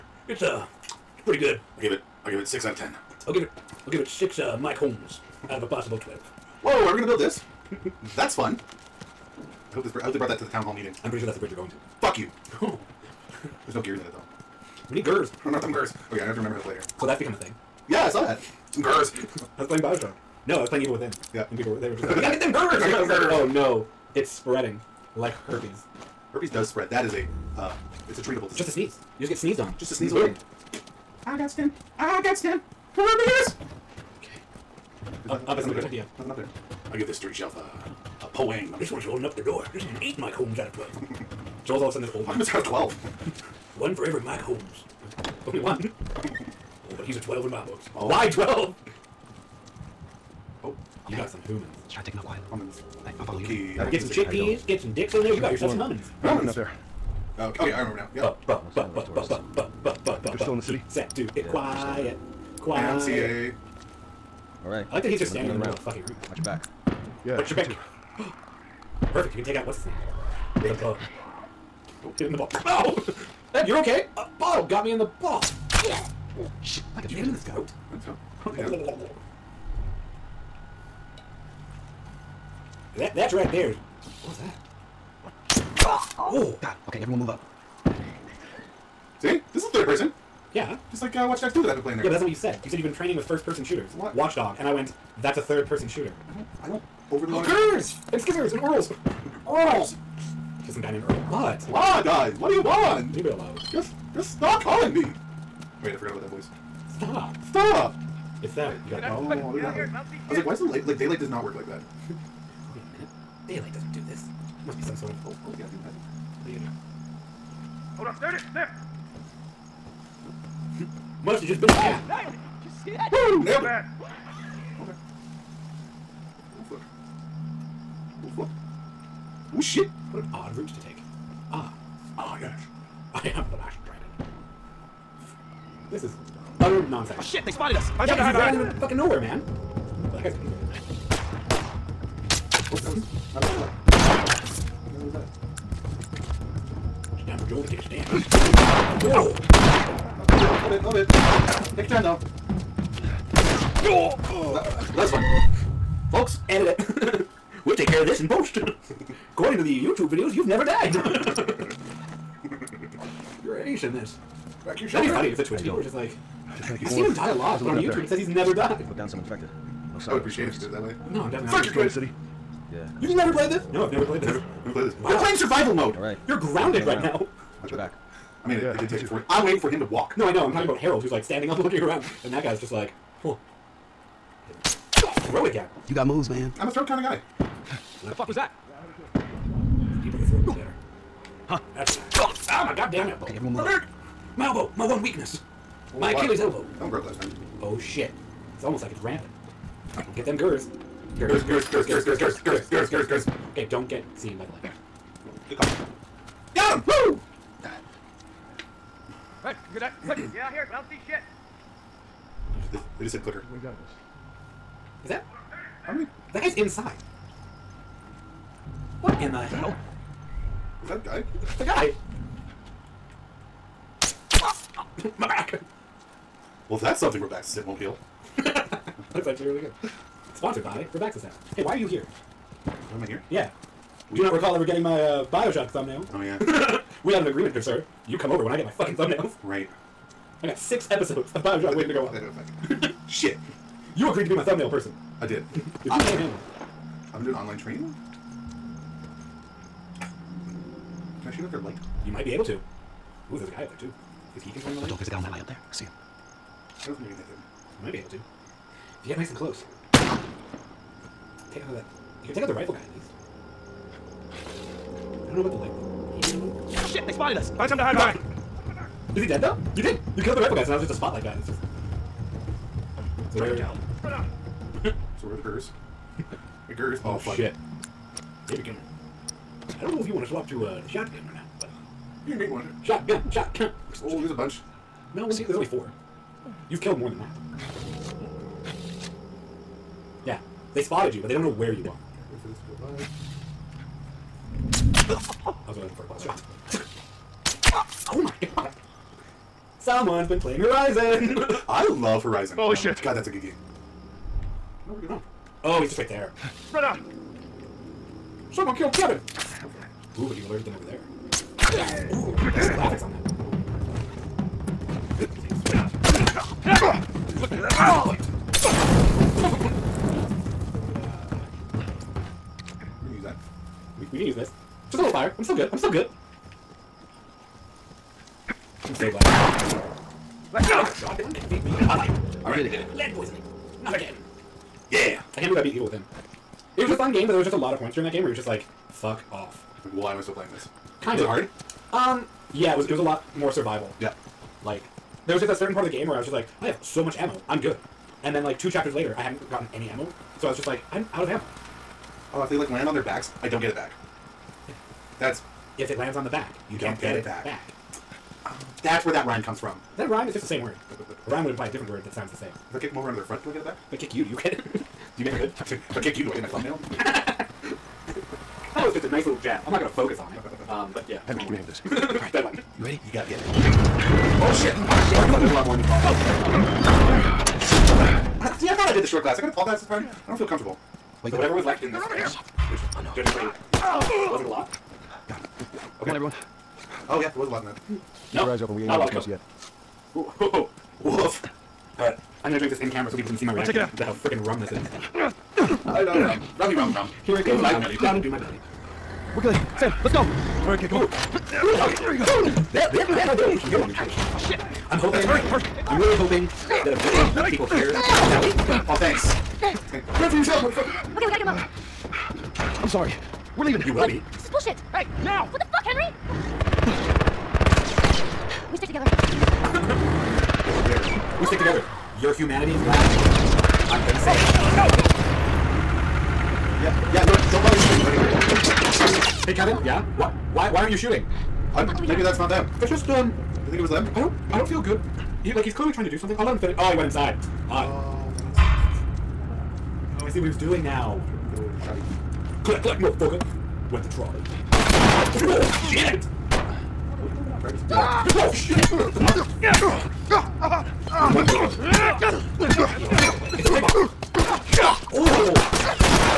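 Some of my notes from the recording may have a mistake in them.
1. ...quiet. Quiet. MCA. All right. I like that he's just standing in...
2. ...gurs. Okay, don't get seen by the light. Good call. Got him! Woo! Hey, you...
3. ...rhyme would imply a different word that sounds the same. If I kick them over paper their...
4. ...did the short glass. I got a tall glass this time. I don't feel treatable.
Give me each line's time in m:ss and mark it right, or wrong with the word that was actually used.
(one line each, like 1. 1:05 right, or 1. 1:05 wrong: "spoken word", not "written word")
1. 1:01 right
2. 3:23 right
3. 6:01 wrong: "under", not "paper"
4. 6:18 wrong: "comfortable", not "treatable".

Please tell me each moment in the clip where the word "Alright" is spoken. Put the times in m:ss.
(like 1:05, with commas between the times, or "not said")
5:32, 6:15.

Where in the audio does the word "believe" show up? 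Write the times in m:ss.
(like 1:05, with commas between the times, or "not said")
5:35.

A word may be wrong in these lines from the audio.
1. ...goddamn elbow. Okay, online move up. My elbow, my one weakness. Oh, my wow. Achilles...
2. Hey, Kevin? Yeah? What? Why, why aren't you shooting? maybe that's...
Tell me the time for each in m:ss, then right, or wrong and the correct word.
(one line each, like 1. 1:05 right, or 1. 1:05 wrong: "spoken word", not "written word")
1. 3:12 wrong: "everyone", not "online"
2. 7:09 right.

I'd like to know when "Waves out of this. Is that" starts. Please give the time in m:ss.
3:33.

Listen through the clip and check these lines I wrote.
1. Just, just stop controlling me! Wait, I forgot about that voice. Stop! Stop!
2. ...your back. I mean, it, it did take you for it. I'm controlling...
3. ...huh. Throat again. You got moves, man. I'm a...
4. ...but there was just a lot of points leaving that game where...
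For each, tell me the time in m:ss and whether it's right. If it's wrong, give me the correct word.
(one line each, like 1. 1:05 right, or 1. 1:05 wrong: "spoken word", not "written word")
1. 1:43 wrong: "calling", not "controlling"
2. 2:57 wrong: "waiting", not "controlling"
3. 3:03 right
4. 5:37 wrong: "during", not "leaving".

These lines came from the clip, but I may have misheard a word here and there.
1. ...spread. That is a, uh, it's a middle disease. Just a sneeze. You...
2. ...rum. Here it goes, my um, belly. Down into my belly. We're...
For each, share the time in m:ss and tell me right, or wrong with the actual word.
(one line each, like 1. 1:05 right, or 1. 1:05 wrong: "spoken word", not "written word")
1. 0:26 wrong: "treatable", not "middle"
2. 6:36 right.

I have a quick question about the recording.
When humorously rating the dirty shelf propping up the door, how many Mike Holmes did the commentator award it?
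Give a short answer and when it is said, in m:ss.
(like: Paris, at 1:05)
8, at 0:40.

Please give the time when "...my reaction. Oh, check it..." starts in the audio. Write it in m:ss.
6:33.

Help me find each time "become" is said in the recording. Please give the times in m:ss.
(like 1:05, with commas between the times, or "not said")
0:17, 4:38.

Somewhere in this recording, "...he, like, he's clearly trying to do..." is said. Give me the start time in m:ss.
7:15.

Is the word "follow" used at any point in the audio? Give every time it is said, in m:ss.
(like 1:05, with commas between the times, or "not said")
0:53.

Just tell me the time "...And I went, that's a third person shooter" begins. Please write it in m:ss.
1:34.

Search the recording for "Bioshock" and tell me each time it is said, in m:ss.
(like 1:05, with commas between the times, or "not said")
0:19, 3:55, 4:01.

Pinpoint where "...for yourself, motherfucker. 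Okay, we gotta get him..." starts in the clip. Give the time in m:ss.
6:50.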